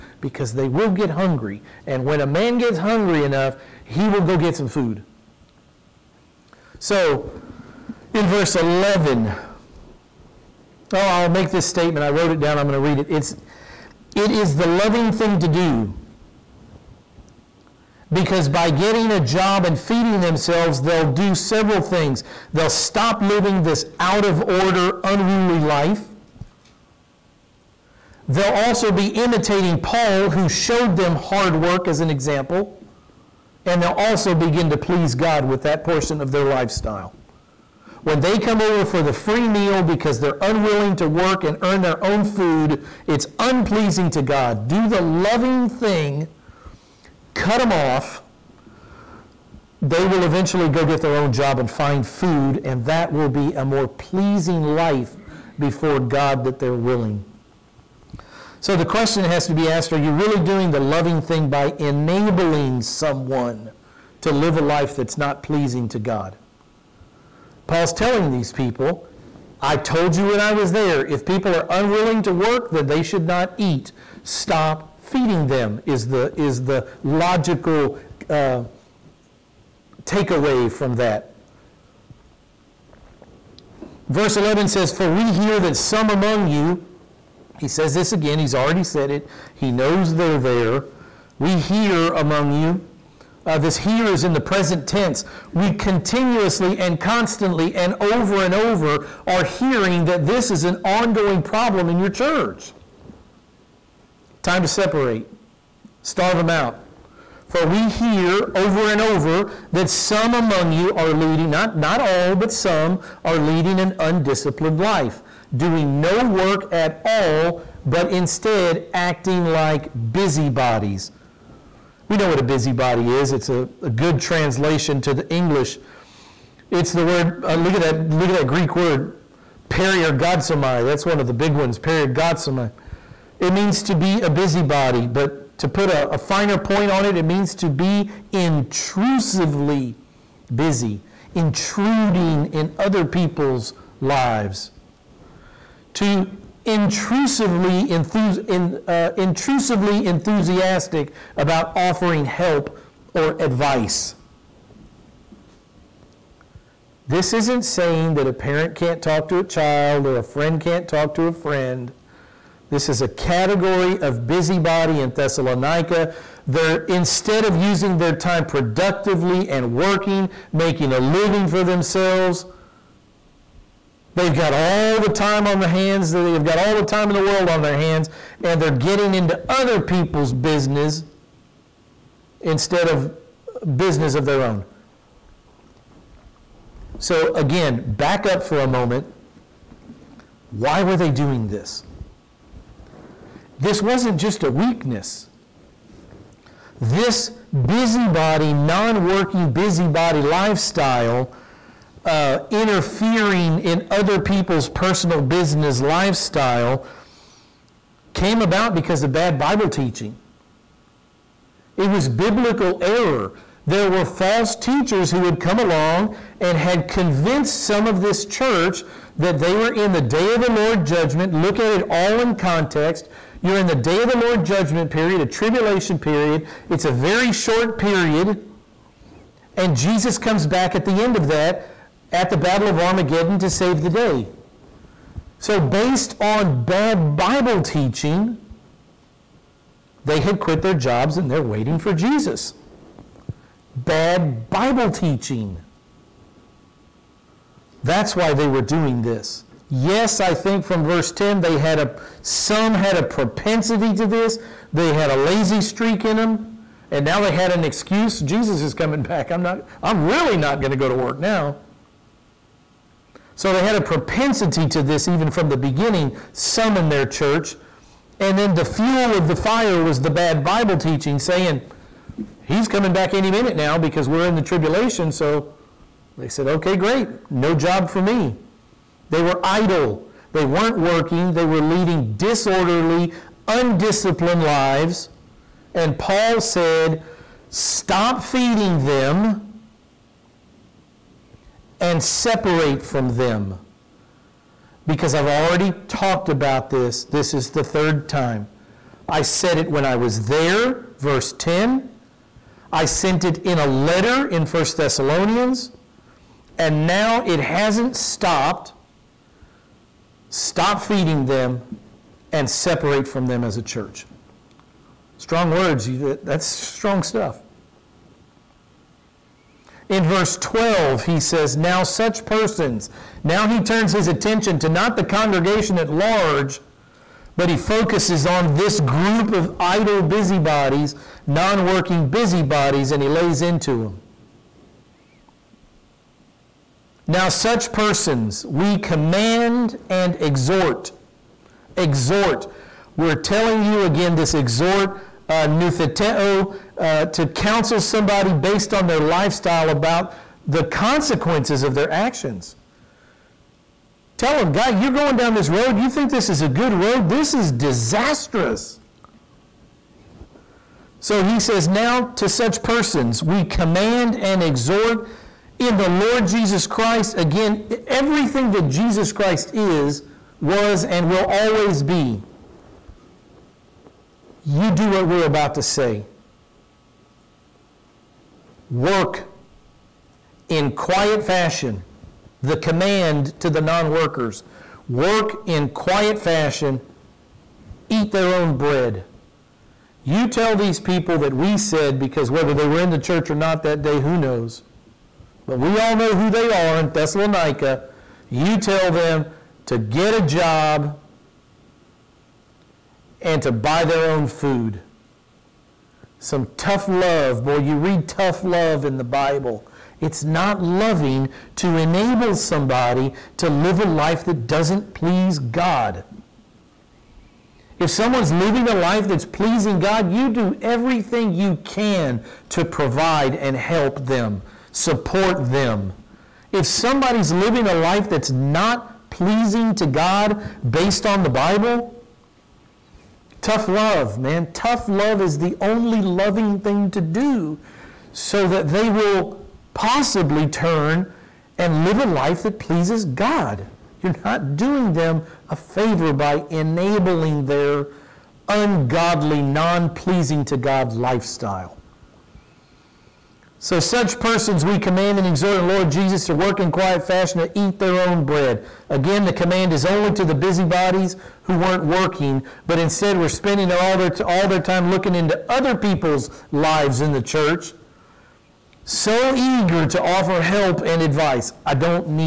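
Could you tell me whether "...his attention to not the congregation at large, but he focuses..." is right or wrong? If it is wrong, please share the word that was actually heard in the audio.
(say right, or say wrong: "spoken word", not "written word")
right.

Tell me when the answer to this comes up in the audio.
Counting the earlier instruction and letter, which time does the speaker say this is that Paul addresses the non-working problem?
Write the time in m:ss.
4:57.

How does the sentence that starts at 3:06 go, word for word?
So, again, back up for a moment.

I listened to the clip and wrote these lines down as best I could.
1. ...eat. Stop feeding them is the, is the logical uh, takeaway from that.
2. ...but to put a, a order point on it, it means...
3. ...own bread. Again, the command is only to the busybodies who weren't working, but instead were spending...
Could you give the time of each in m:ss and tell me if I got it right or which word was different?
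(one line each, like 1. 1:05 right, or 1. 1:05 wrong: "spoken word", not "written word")
1. 1:13 right
2. 2:15 wrong: "finer", not "order"
3. 7:37 right.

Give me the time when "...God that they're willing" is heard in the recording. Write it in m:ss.
0:55.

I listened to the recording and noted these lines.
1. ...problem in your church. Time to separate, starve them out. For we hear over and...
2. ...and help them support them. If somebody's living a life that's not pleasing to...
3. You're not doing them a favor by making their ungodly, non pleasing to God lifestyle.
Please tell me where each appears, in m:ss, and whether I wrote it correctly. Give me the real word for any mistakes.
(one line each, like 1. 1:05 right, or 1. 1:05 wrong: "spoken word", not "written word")
1. 1:41 right
2. 7:03 right
3. 7:24 wrong: "enabling", not "making".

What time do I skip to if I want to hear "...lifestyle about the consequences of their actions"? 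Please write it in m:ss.
5:48.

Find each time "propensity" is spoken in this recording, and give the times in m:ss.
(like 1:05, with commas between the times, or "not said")
4:13, 4:23.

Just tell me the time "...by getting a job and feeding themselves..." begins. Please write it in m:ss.
0:18.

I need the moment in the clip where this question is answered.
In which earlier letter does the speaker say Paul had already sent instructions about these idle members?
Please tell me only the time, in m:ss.
5:04.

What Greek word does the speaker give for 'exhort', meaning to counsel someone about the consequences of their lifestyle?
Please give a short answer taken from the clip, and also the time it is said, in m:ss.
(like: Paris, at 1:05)
nutheteo, at 5:45.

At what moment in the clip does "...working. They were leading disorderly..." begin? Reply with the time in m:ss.
4:40.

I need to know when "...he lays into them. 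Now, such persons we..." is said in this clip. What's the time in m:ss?
5:33.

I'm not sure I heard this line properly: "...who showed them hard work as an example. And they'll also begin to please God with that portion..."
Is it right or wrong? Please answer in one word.
right.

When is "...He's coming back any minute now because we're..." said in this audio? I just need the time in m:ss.
4:32.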